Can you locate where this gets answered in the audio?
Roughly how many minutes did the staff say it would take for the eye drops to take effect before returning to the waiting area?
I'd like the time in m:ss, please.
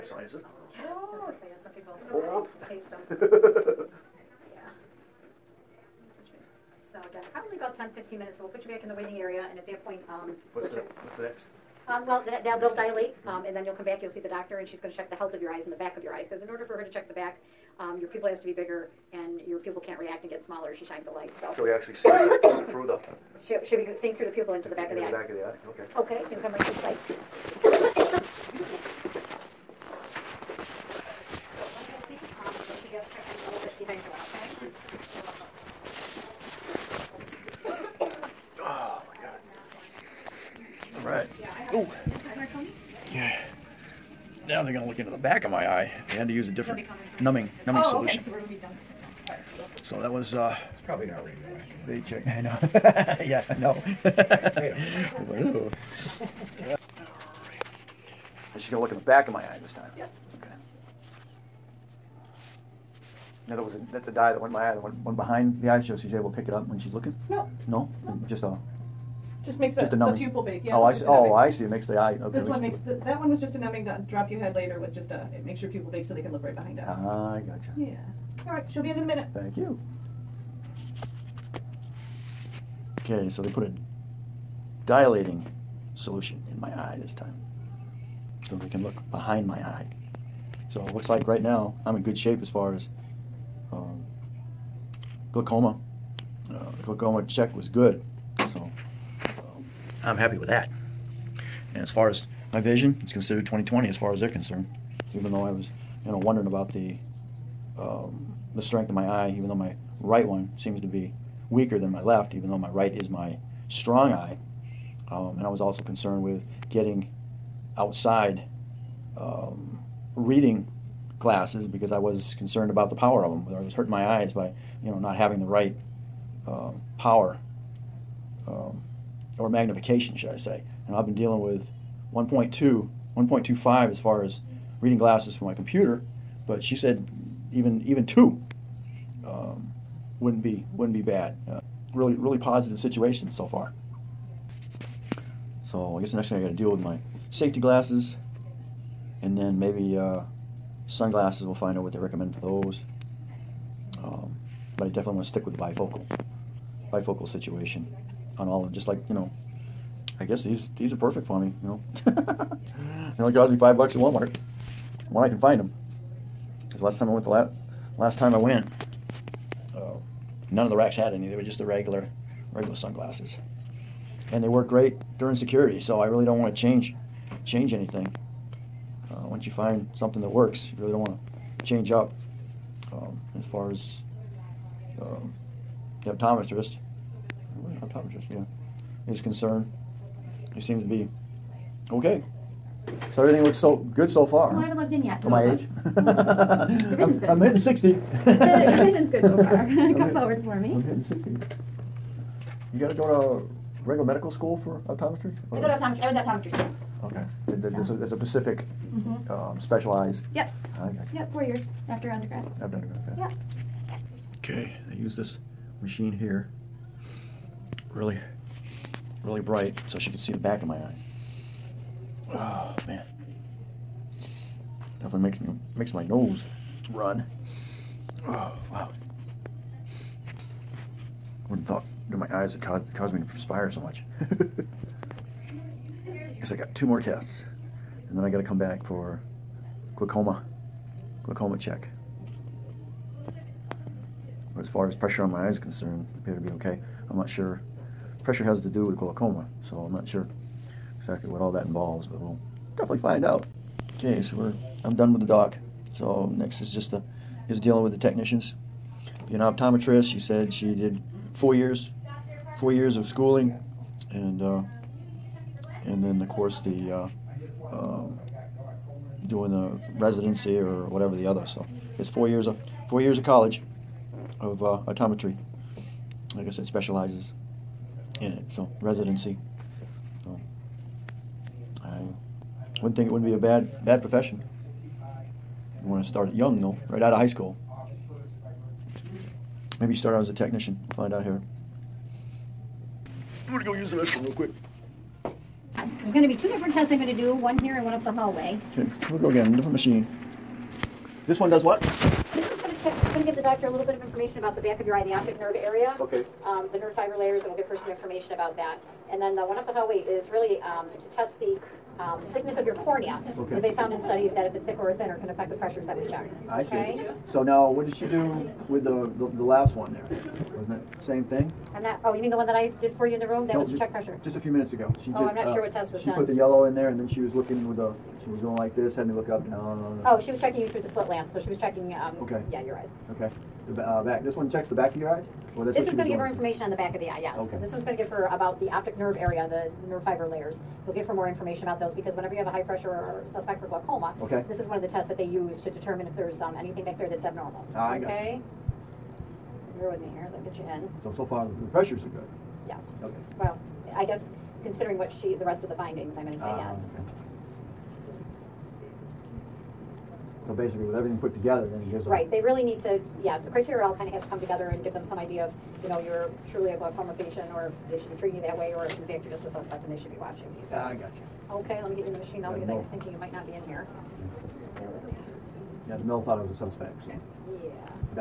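0:07.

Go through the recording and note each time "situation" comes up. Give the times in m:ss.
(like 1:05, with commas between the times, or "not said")
2:22, 2:37.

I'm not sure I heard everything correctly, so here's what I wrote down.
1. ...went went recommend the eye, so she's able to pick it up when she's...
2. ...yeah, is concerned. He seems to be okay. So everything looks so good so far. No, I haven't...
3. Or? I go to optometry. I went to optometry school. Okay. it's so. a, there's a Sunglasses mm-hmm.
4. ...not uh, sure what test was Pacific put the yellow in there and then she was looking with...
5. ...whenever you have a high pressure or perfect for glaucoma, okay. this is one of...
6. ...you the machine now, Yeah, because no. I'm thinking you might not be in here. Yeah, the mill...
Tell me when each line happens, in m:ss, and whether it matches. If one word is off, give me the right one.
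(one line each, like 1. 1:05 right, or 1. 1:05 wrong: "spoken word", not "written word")
1. 1:04 wrong: "behind", not "recommend"
2. 3:08 right
3. 3:25 wrong: "Pacific", not "Sunglasses"
4. 5:25 wrong: "She", not "Pacific"
5. 5:42 wrong: "suspect", not "perfect"
6. 6:12 right.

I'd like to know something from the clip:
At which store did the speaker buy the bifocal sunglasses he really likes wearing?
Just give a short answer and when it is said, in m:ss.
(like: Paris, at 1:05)
Walmart, at 2:43.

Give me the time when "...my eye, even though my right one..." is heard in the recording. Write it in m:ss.
1:48.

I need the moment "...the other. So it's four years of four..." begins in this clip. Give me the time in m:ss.
4:31.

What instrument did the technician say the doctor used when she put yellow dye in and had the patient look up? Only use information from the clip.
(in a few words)
Slit lamp.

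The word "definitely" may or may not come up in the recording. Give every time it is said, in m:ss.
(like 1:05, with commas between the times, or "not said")
2:34, 3:45, 4:12.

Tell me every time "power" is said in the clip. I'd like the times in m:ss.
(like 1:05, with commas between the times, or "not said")
2:02, 2:06.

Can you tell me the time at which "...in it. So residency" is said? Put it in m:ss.
4:38.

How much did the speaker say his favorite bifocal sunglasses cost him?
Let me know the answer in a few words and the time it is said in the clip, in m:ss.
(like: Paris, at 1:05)
5 dollars, at 2:43.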